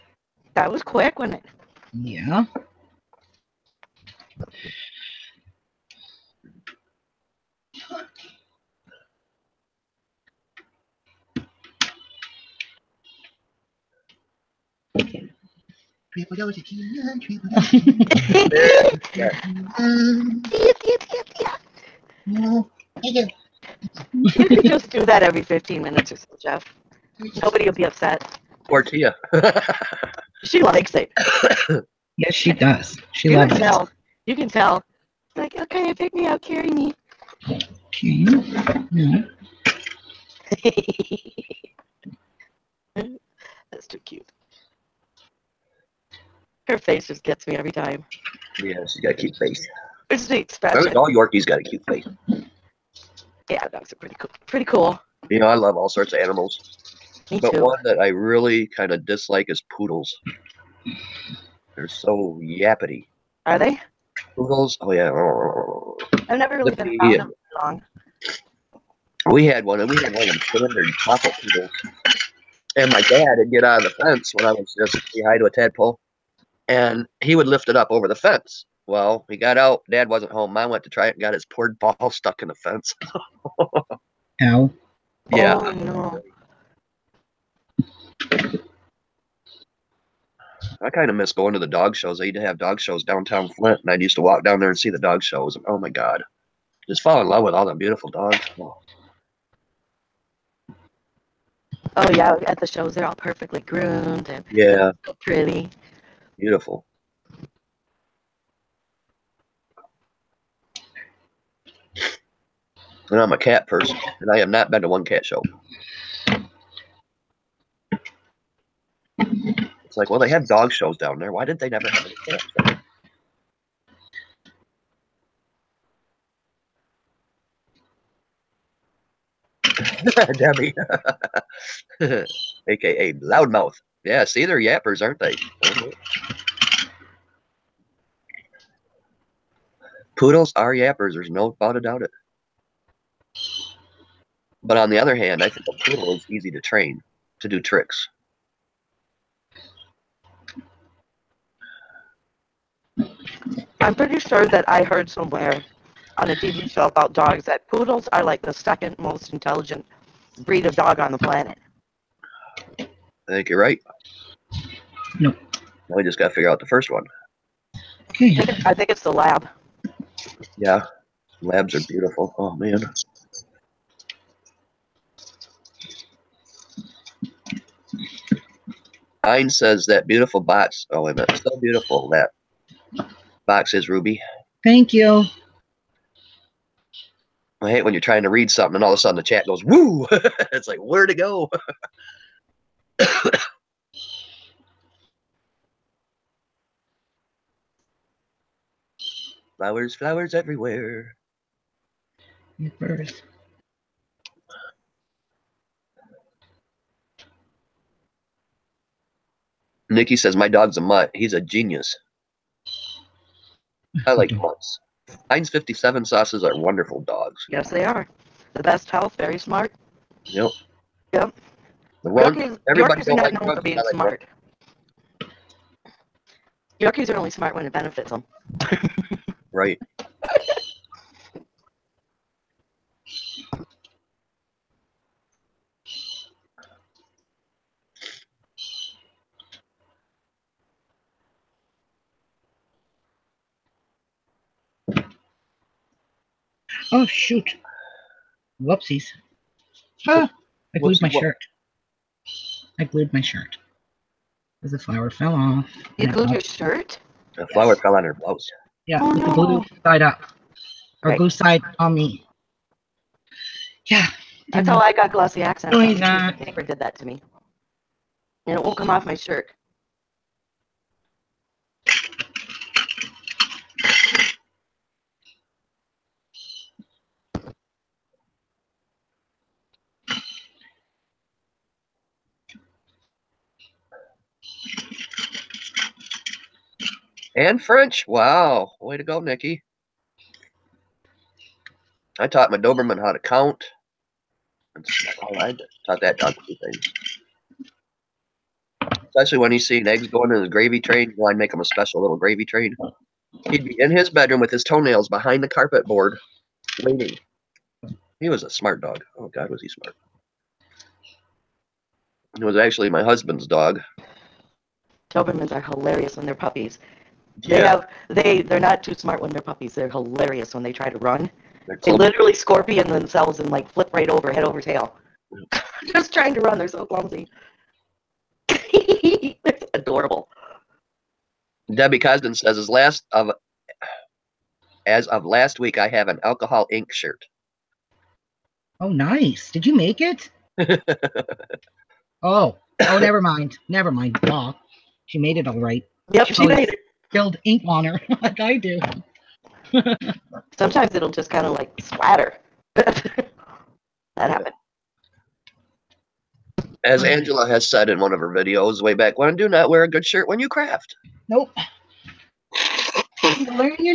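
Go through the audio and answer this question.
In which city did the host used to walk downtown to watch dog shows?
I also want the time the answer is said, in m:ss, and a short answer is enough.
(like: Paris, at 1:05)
Flint, at 1:33.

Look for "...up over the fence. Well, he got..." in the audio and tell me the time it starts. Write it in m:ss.
1:17.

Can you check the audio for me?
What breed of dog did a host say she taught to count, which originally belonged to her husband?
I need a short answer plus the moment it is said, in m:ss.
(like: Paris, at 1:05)
Doberman, at 4:52.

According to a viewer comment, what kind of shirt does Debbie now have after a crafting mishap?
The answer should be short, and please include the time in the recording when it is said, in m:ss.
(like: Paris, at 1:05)
Alcohol ink shirt, at 5:36.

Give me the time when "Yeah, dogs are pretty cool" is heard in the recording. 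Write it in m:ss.
0:53.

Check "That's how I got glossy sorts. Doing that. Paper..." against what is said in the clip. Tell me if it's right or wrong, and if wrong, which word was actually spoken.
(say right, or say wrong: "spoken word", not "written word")
wrong: "accents", not "sorts".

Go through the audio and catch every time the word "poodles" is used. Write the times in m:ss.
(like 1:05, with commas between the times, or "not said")
0:59, 1:04, 1:11, 2:20, 2:25, 2:37.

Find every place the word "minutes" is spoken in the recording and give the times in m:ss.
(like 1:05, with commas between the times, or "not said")
0:25, 3:01.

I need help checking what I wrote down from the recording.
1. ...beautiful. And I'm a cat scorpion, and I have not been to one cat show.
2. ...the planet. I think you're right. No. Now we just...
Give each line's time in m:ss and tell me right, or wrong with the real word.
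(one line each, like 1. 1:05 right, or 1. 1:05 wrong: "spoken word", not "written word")
1. 1:46 wrong: "person", not "scorpion"
2. 2:41 right.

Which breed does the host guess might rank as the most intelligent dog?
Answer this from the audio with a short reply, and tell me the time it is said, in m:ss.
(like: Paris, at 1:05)
Lab, at 2:49.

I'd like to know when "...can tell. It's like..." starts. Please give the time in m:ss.
0:34.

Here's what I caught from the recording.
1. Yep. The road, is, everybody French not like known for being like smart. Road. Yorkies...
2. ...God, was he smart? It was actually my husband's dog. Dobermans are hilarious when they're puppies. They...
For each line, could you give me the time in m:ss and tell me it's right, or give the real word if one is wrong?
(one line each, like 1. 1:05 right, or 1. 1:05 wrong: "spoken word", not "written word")
1. 3:41 wrong: "York", not "French"
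2. 5:09 right.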